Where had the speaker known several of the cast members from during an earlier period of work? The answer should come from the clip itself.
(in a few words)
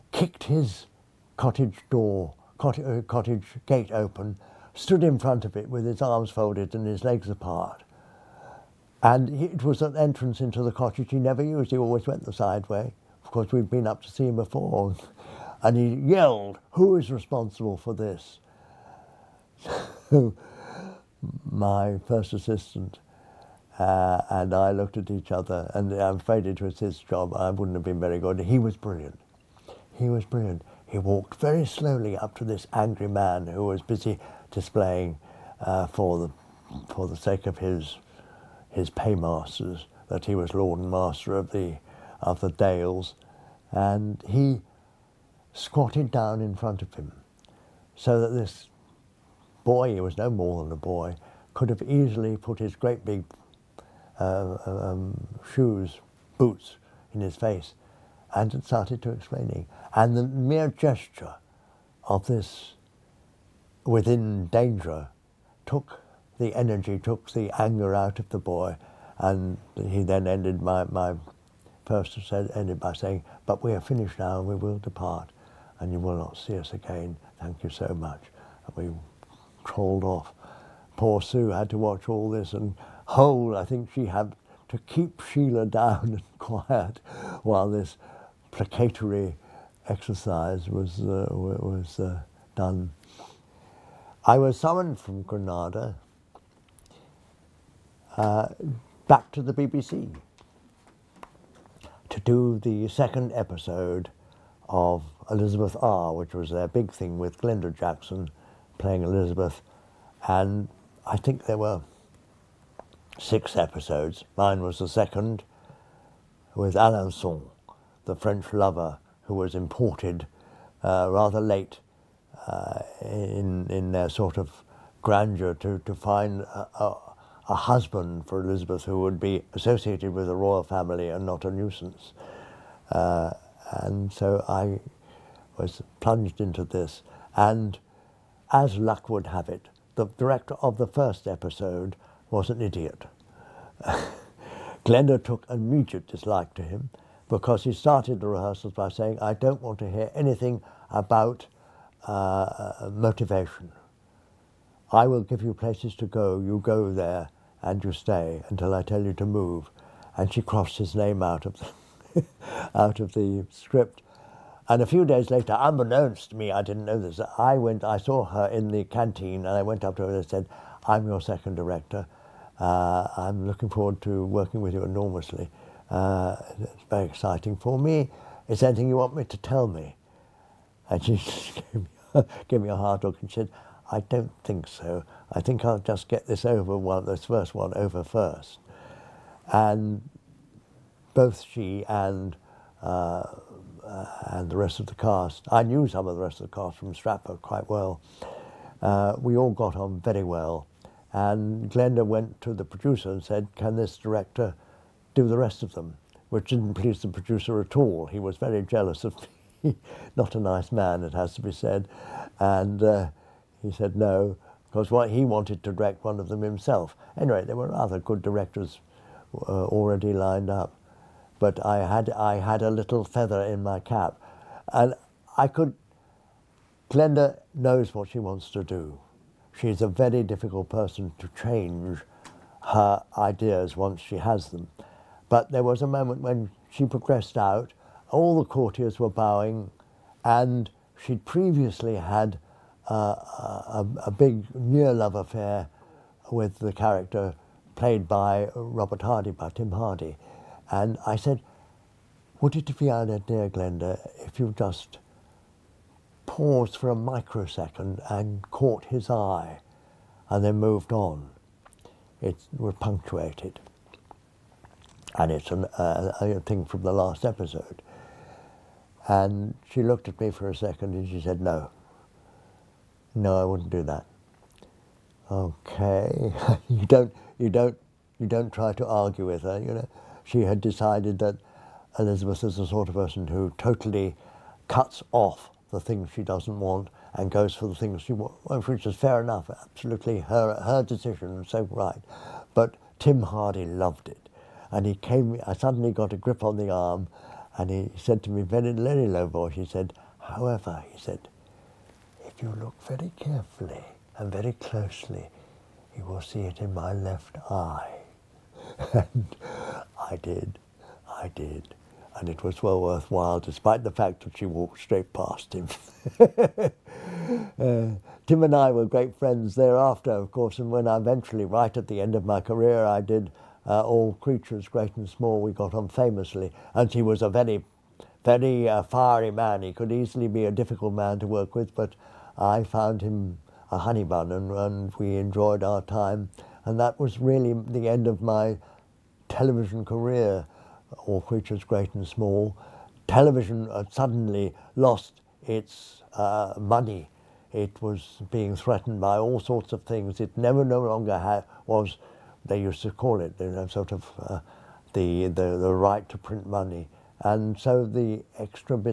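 Stratford.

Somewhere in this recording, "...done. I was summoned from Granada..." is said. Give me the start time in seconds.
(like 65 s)
92 s.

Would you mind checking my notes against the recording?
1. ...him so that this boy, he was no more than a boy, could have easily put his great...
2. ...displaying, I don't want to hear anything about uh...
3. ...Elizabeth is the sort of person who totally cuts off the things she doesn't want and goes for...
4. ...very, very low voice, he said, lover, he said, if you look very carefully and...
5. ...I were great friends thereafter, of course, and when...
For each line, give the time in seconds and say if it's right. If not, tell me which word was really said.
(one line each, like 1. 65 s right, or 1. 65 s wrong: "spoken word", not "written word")
1. 46 s right
2. 148 s wrong: "saying", not "displaying"
3. 281 s right
4. 298 s wrong: "however", not "lover"
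5. 318 s right.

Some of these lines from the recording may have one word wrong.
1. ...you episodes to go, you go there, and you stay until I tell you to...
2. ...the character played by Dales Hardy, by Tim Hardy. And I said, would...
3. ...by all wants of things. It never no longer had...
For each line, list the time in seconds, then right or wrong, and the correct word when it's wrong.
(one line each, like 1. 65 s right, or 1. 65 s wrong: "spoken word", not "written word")
1. 155 s wrong: "places", not "episodes"
2. 246 s wrong: "Robert", not "Dales"
3. 348 s wrong: "sorts", not "wants".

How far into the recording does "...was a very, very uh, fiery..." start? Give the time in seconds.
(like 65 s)
327 s.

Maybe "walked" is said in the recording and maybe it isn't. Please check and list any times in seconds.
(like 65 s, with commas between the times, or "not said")
30 s, 314 s.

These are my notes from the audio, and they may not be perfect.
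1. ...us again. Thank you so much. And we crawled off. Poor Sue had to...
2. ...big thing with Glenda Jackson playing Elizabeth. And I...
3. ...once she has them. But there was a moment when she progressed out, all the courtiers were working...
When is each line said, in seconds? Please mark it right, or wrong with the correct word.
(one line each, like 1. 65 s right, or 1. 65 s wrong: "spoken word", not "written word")
1. 76 s right
2. 106 s right
3. 233 s wrong: "bowing", not "working".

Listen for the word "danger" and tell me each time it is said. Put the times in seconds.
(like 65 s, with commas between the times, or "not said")
64 s.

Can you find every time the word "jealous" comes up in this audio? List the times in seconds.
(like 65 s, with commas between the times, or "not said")
208 s.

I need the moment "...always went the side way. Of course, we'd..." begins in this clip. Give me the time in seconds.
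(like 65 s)
11 s.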